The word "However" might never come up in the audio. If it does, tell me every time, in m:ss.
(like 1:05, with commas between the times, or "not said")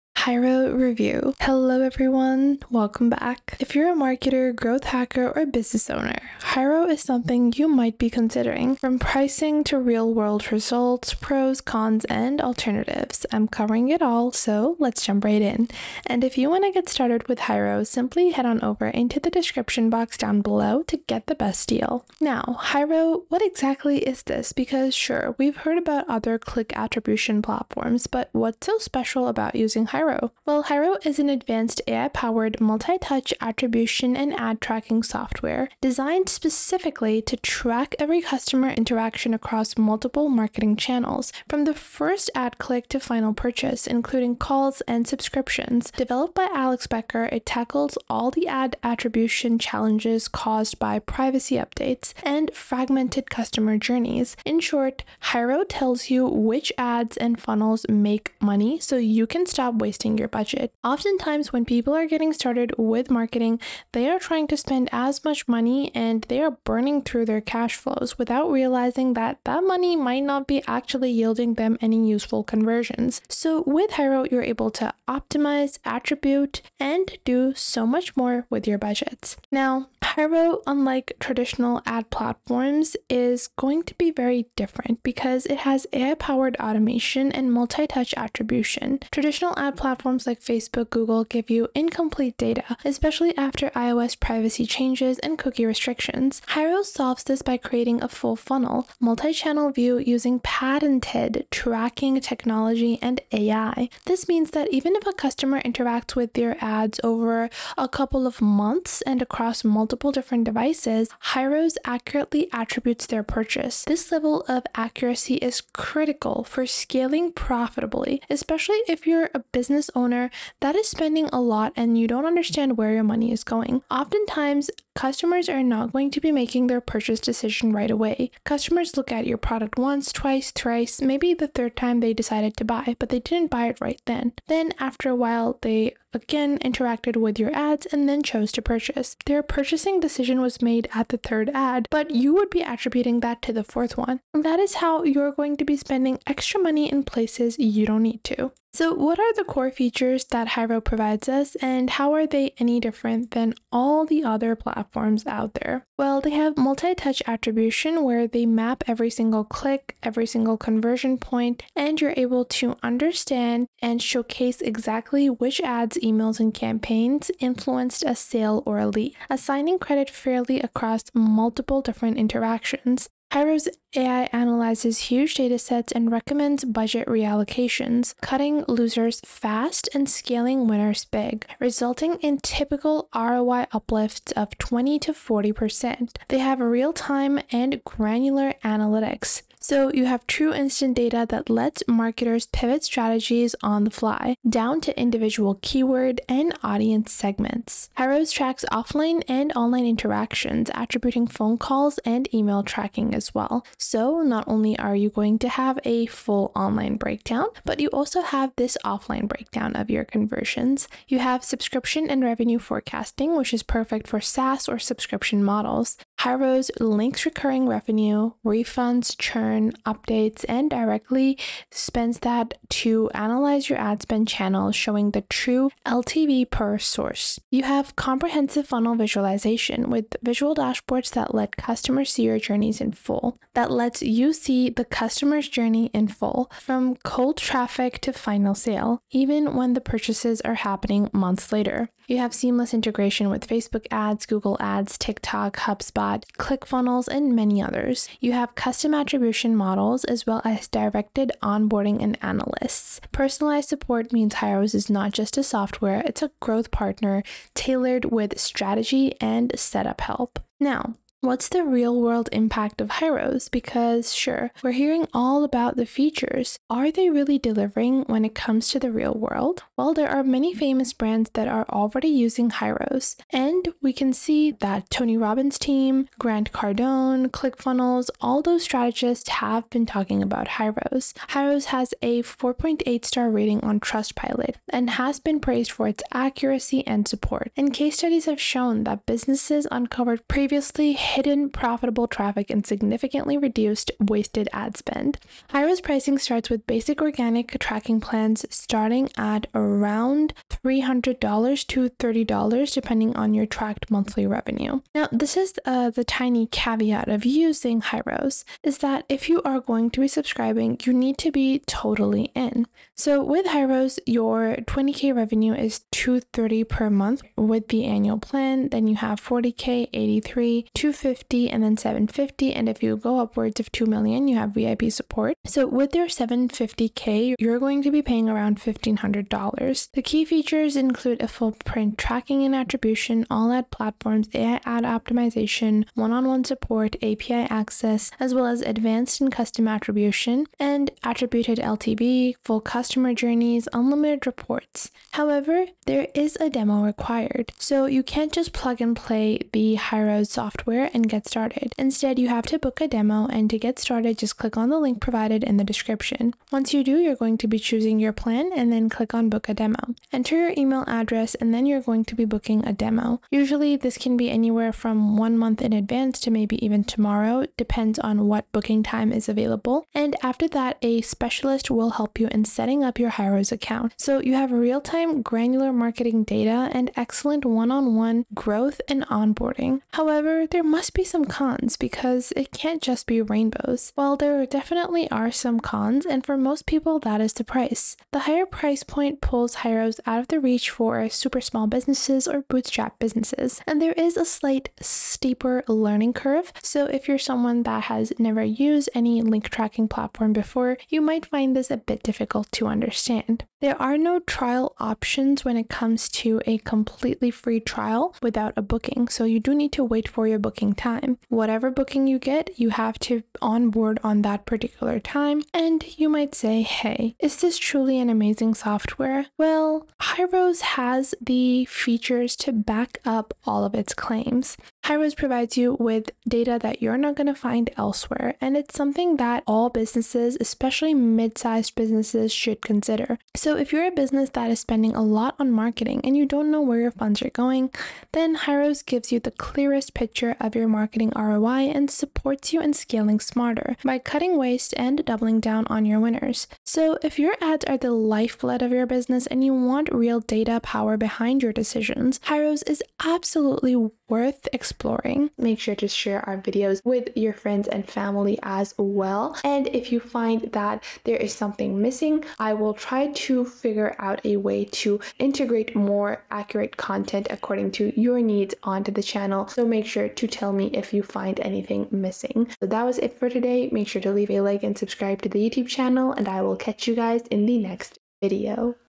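5:45, 6:19.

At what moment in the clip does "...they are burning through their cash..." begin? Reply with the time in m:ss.
1:06.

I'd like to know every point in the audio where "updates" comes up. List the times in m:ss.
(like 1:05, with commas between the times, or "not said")
0:51, 3:39.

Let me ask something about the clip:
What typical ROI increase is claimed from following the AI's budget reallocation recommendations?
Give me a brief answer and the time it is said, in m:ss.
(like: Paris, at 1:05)
20 to 40%, at 3:04.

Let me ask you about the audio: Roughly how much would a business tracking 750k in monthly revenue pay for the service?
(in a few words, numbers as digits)
$1,500.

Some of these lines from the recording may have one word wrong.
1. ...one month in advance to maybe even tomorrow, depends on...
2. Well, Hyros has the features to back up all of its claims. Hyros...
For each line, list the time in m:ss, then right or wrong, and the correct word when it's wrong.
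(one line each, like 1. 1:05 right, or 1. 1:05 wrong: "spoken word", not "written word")
1. 6:05 right
2. 6:59 right.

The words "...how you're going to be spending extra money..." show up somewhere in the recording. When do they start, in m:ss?
2:24.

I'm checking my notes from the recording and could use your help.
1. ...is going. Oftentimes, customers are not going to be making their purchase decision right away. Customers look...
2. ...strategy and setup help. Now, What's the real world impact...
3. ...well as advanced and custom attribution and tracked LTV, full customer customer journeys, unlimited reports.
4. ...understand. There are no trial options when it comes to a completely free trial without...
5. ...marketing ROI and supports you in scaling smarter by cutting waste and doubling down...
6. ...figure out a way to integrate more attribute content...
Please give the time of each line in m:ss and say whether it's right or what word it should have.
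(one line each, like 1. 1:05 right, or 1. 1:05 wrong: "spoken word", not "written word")
1. 2:03 right
2. 4:18 right
3. 5:38 wrong: "attributed", not "tracked"
4. 6:42 right
5. 7:20 right
6. 7:43 wrong: "accurate", not "attribute".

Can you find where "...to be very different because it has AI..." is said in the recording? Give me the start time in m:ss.
1:23.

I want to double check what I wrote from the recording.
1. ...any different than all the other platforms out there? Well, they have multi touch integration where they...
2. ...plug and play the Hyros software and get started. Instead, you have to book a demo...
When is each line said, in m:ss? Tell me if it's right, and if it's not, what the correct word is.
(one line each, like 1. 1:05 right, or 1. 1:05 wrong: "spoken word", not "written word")
1. 2:32 wrong: "attribution", not "integration"
2. 5:48 right.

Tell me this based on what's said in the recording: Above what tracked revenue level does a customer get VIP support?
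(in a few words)
2 million.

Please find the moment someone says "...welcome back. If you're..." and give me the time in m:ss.
0:02.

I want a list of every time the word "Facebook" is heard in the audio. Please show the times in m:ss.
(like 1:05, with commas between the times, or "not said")
1:30, 4:03.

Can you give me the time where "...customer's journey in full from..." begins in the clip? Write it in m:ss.
3:54.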